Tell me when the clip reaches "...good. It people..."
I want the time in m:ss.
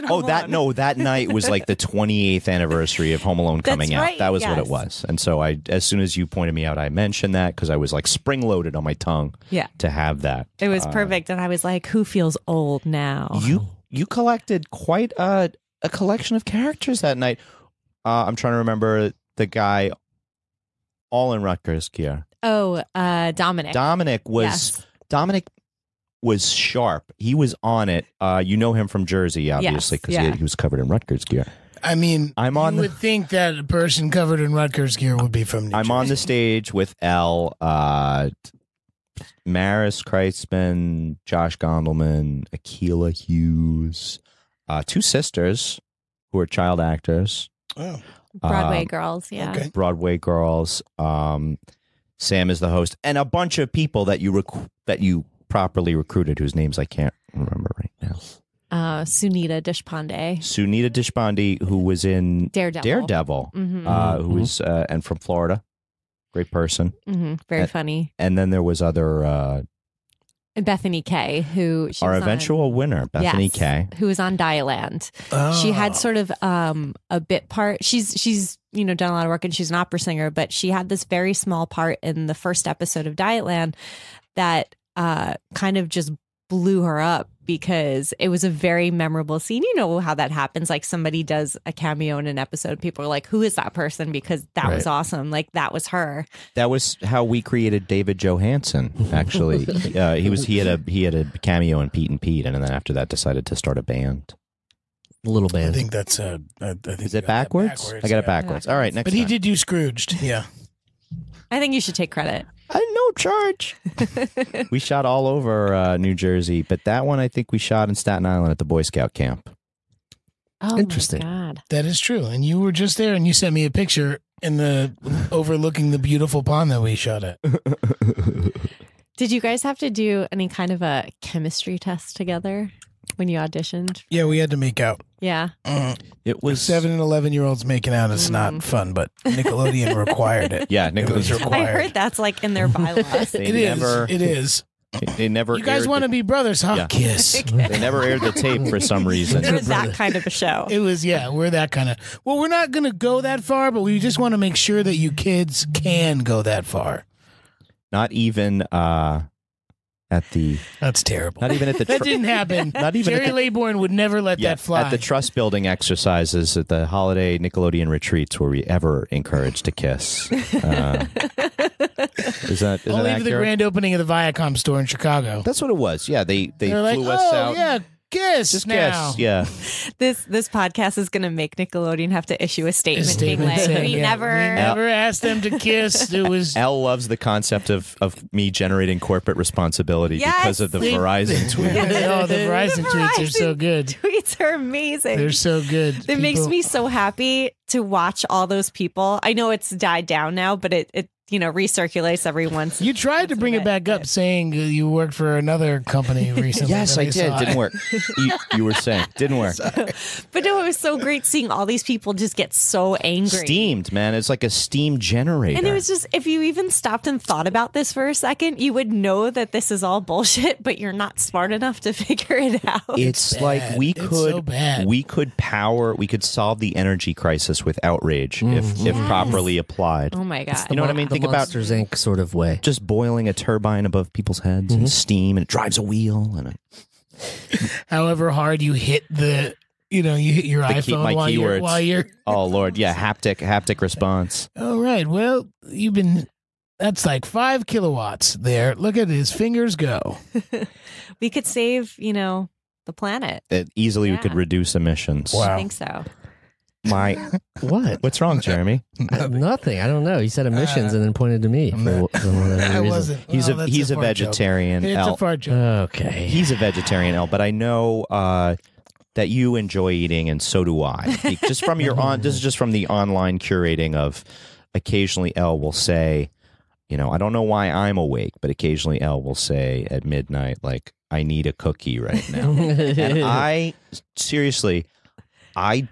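3:15.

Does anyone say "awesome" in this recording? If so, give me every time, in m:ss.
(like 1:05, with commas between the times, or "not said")
1:34.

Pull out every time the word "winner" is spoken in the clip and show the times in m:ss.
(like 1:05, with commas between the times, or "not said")
1:12.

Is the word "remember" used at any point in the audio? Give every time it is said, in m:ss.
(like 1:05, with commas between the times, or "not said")
0:18, 0:57.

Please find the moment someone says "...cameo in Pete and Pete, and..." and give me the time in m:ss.
1:41.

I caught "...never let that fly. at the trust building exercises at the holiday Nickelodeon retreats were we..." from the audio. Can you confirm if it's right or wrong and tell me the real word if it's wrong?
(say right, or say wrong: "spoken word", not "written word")
right.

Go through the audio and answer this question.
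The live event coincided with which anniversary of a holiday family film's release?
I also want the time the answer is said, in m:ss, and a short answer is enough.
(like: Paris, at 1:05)
28th, at 0:01.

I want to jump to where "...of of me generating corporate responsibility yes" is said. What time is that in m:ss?
3:07.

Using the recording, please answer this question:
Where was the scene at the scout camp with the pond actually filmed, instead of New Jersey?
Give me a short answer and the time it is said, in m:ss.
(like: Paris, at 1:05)
Staten Island, at 1:57.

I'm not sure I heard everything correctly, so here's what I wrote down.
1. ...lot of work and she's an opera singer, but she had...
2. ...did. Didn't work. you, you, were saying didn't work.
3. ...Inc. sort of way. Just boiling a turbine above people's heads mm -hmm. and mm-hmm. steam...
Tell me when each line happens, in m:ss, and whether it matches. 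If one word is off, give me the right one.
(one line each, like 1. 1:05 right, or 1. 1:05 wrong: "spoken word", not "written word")
1. 1:19 right
2. 3:27 right
3. 3:51 right.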